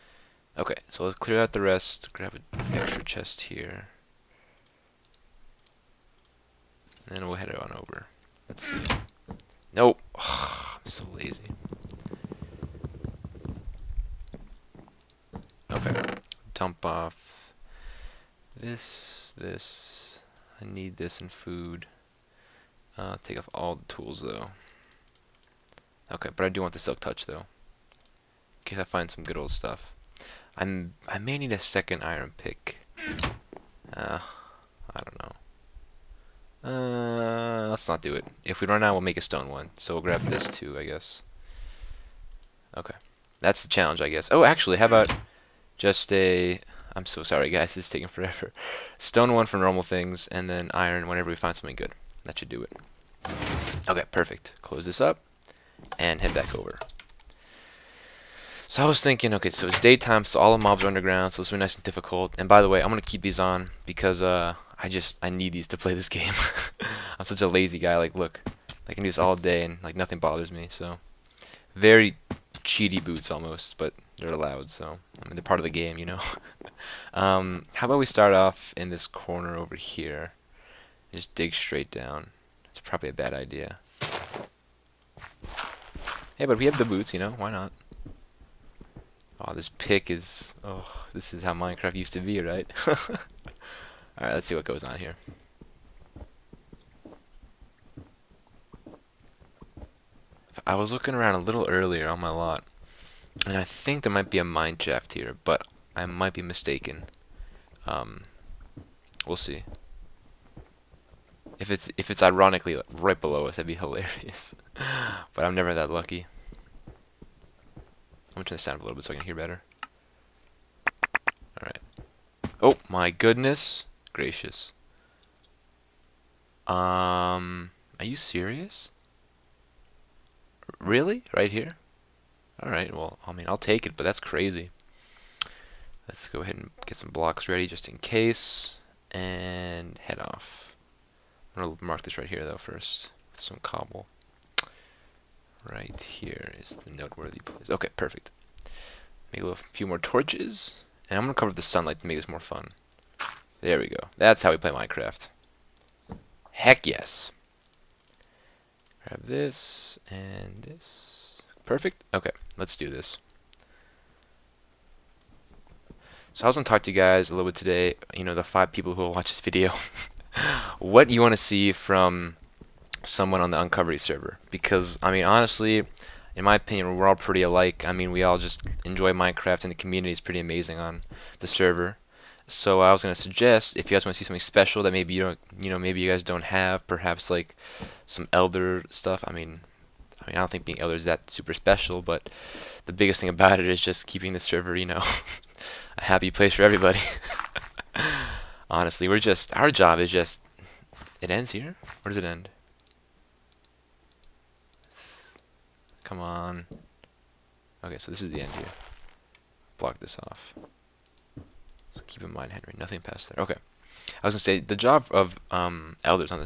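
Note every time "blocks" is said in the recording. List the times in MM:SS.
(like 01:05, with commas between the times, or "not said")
02:17, 03:29.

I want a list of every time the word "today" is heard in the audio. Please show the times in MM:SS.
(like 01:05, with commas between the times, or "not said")
02:47.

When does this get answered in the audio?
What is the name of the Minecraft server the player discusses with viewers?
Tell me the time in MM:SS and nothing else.
02:53.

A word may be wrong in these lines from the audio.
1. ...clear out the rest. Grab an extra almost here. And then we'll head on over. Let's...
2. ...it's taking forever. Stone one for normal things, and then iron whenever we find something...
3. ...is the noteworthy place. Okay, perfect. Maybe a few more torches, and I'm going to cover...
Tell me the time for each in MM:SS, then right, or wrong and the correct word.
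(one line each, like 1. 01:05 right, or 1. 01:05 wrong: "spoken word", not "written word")
1. 00:01 wrong: "chest", not "almost"
2. 00:47 right
3. 02:26 right.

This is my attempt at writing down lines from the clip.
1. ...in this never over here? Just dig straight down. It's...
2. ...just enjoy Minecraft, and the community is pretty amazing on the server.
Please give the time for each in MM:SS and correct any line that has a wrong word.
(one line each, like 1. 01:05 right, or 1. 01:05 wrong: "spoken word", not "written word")
1. 01:18 wrong: "corner", not "never"
2. 02:58 right.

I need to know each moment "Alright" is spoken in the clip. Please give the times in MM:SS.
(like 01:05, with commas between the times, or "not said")
01:32, 02:01.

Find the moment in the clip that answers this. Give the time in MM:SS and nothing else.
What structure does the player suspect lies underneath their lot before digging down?
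01:44.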